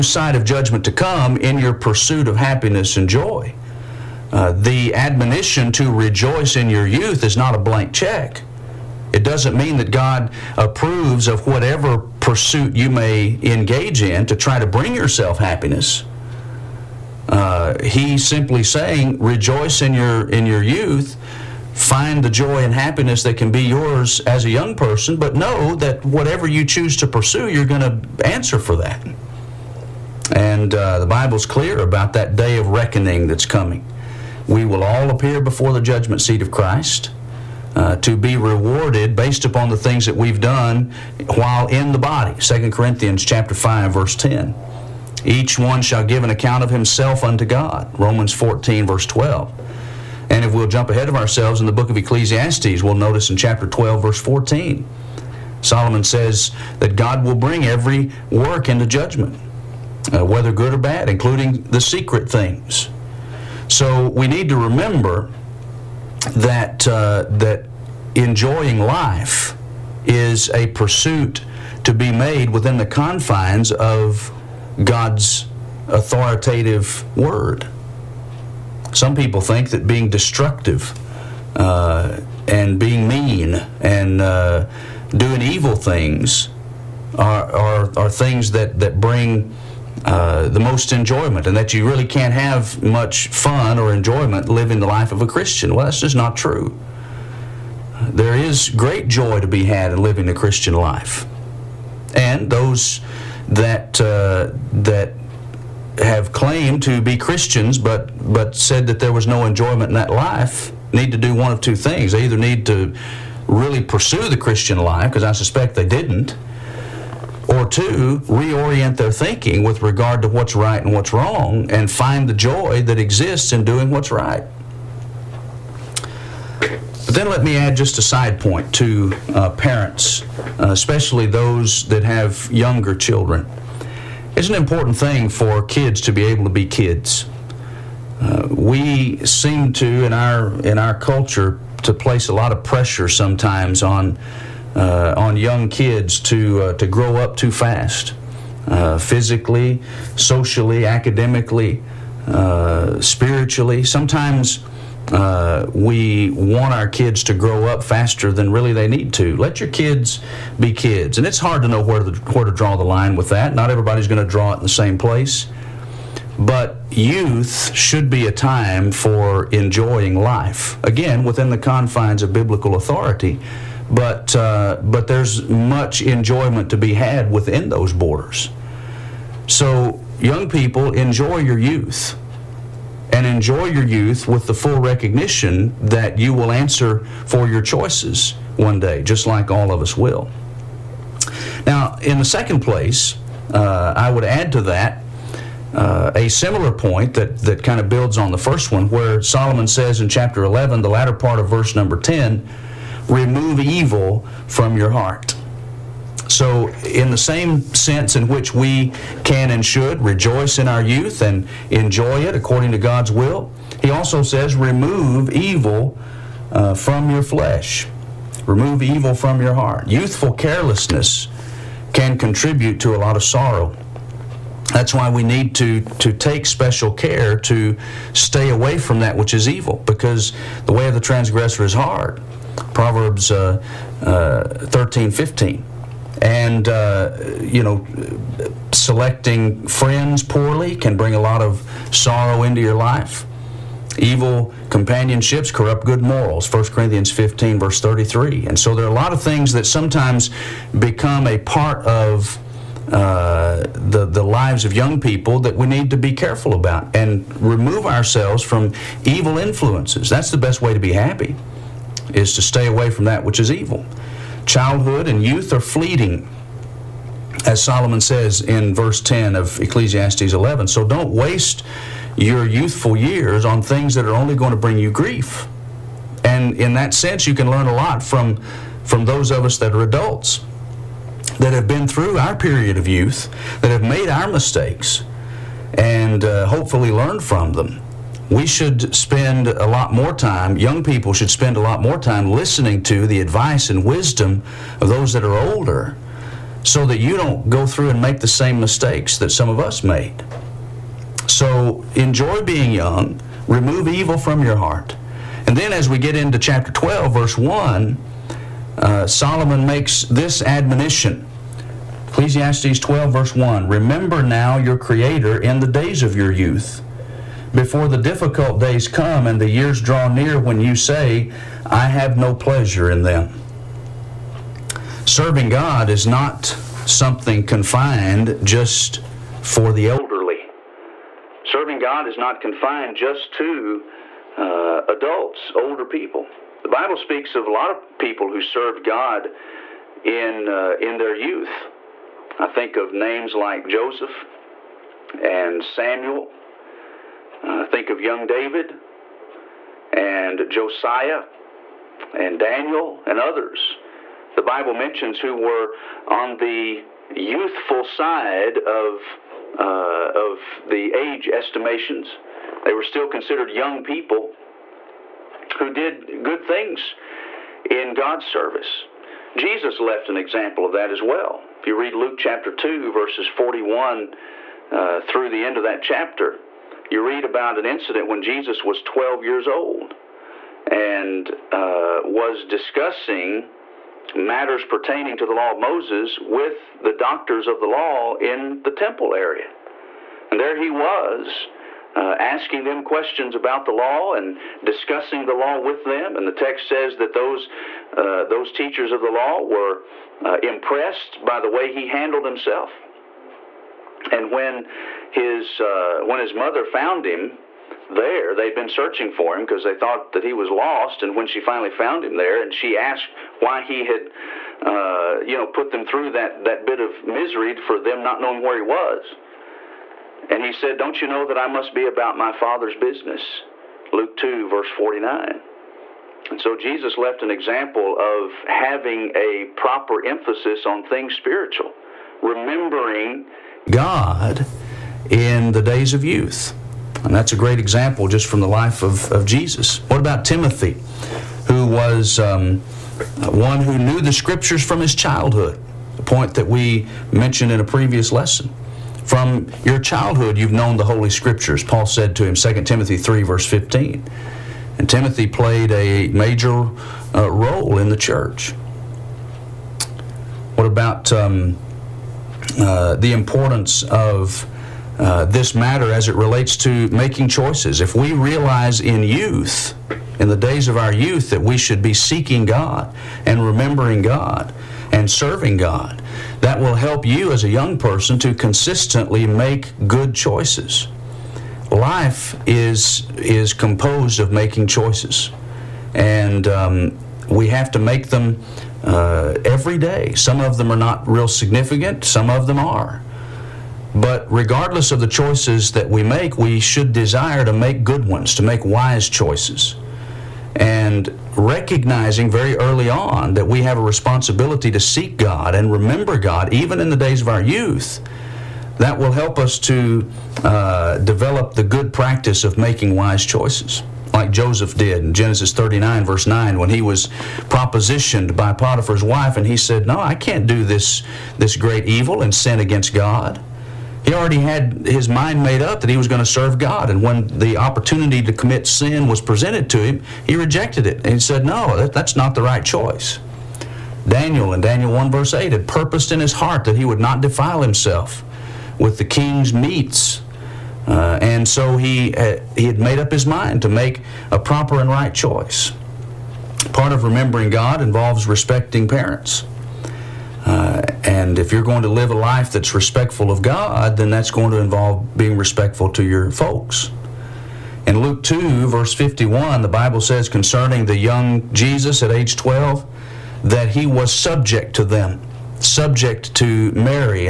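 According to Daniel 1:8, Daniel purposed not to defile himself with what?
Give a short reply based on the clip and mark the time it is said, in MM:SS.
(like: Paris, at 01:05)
The king's meats, at 08:59.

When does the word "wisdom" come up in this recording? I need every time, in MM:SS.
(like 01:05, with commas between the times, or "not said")
04:53.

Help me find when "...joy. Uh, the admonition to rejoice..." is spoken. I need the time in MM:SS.
00:03.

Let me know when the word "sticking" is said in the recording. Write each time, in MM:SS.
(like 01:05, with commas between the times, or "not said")
not said.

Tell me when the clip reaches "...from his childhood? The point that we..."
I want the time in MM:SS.
07:24.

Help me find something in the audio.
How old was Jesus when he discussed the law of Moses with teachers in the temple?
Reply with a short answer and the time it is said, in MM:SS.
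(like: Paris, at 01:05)
12, at 06:18.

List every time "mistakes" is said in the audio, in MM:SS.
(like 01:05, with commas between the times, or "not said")
04:44, 04:58.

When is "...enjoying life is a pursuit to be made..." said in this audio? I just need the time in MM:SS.
01:08.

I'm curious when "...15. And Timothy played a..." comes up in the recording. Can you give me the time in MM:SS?
07:33.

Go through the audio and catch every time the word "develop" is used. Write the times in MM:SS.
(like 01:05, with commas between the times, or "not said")
08:30.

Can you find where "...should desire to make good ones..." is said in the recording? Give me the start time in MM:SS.
08:16.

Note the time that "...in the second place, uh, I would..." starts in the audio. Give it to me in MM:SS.
03:12.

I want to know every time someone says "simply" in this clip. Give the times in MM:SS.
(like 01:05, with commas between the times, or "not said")
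00:18.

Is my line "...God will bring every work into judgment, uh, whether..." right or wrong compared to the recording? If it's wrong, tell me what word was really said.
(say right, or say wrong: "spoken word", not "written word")
right.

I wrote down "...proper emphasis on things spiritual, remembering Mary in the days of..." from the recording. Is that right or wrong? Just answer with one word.
wrong.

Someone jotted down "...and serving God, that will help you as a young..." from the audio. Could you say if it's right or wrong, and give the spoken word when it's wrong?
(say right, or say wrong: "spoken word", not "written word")
right.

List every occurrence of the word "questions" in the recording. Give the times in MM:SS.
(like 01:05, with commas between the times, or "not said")
06:32.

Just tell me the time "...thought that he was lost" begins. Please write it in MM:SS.
06:49.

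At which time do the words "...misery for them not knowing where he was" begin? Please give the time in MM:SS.
06:57.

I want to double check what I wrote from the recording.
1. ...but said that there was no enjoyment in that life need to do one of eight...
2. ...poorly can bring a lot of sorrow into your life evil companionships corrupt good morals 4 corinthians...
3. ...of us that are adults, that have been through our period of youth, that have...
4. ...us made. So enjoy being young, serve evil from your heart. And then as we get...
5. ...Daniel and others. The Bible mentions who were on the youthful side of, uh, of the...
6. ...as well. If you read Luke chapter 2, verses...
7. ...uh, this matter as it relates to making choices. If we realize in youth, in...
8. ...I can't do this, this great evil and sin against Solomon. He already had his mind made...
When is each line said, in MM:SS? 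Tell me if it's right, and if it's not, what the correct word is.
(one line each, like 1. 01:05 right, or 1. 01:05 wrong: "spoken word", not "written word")
1. 01:48 wrong: "two", not "eight"
2. 04:00 wrong: "1", not "4"
3. 04:39 right
4. 04:59 wrong: "remove", not "serve"
5. 05:52 right
6. 06:10 right
7. 07:44 right
8. 08:39 wrong: "God", not "Solomon".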